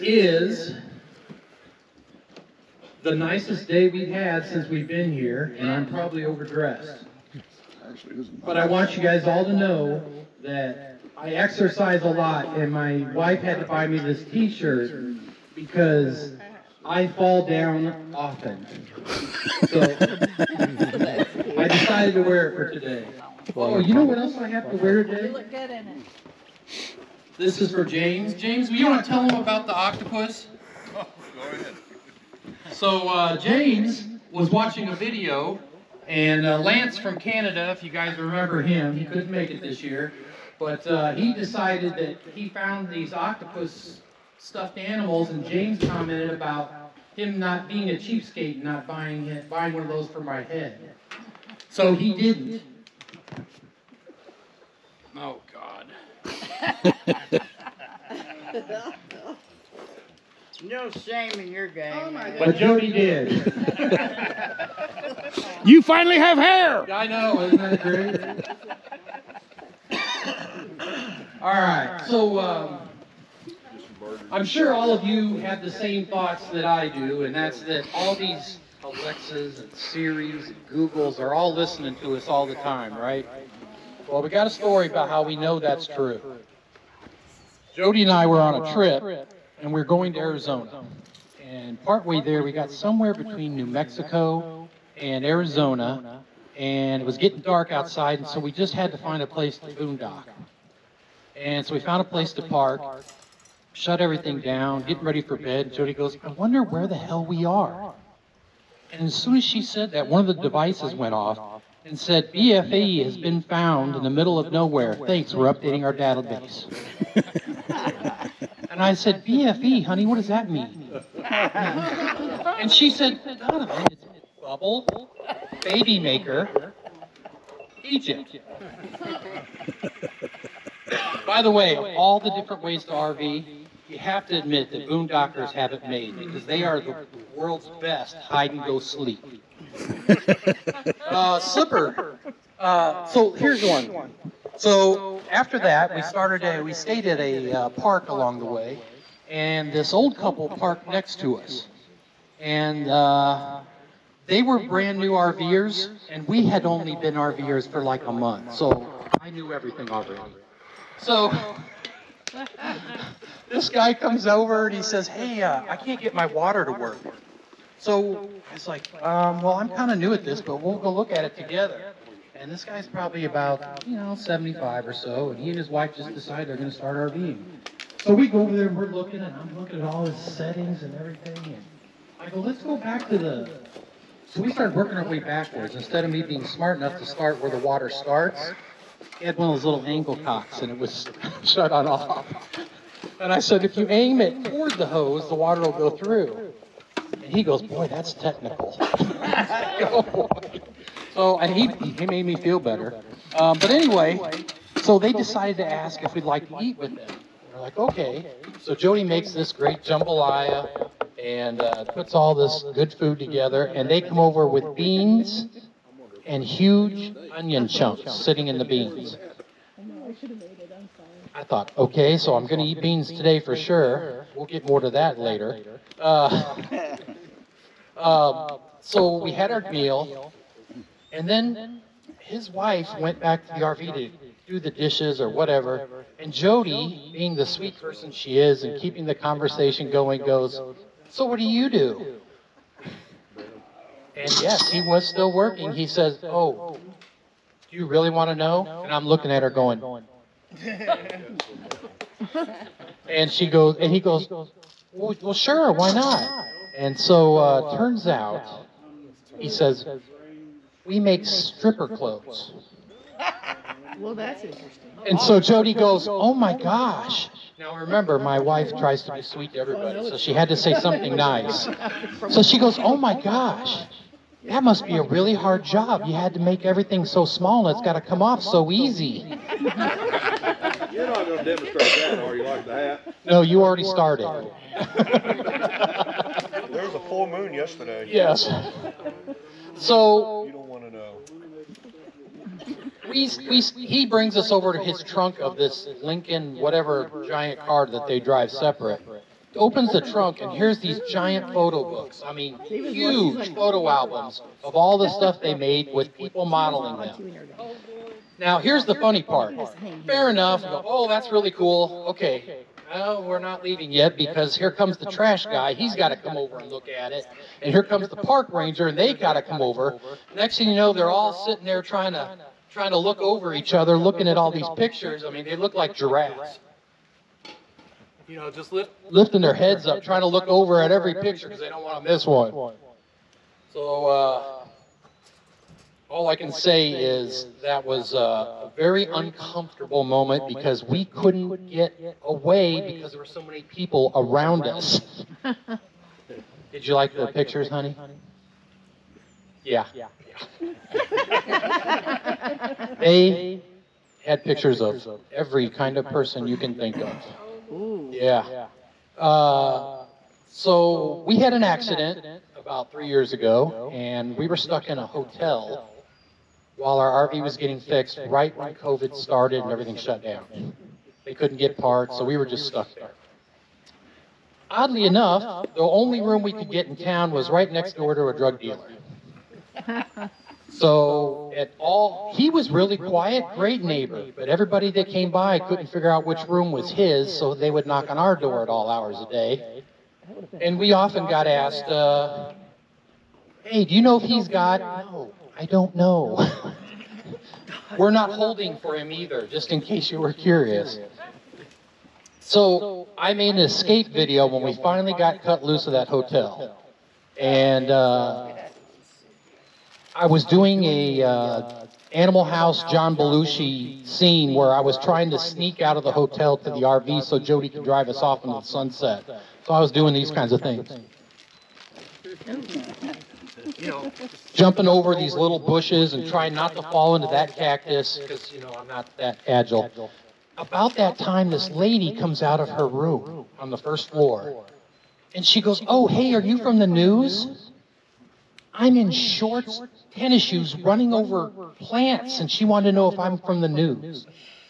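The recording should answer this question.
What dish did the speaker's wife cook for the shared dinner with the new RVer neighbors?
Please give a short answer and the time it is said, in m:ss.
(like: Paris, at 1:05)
jambalaya, at 3:29.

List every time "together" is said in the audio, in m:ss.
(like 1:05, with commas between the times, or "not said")
2:51, 3:33.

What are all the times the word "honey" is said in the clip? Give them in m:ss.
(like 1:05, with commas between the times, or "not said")
1:59, 5:47.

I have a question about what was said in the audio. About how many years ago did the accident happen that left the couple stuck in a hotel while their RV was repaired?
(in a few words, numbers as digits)
3.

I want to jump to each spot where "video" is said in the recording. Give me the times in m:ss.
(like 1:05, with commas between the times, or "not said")
0:34, 6:44.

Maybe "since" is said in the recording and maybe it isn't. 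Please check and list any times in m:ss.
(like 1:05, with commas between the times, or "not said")
0:04.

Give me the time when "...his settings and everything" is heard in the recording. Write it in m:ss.
3:00.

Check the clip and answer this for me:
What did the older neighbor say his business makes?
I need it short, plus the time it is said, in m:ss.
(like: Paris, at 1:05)
stripper clothes, at 4:21.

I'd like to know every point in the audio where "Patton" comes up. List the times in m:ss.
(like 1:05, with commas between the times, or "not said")
not said.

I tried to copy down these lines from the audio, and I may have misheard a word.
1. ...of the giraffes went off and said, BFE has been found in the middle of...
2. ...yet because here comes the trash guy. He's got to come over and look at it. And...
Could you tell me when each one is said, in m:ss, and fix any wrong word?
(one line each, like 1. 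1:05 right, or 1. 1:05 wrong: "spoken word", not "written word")
1. 1:50 wrong: "devices", not "giraffes"
2. 5:13 right.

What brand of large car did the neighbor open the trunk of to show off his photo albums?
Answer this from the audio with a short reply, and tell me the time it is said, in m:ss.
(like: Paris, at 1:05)
Lincoln, at 4:56.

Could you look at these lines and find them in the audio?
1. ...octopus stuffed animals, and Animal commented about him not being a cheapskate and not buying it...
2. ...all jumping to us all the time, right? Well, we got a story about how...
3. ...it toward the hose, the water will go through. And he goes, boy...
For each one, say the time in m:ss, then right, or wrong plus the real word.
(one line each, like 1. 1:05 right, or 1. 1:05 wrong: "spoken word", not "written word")
1. 0:43 wrong: "James", not "Animal"
2. 1:21 wrong: "listening", not "jumping"
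3. 3:14 right.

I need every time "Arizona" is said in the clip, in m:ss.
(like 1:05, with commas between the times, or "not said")
1:30, 1:35.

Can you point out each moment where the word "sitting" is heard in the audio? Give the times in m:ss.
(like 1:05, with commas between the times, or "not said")
3:38, 5:21.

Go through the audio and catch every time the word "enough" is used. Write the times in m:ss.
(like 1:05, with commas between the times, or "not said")
3:06, 5:10, 6:15.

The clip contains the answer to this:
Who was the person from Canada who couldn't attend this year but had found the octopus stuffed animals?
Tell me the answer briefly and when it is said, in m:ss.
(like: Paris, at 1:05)
Lance, at 0:36.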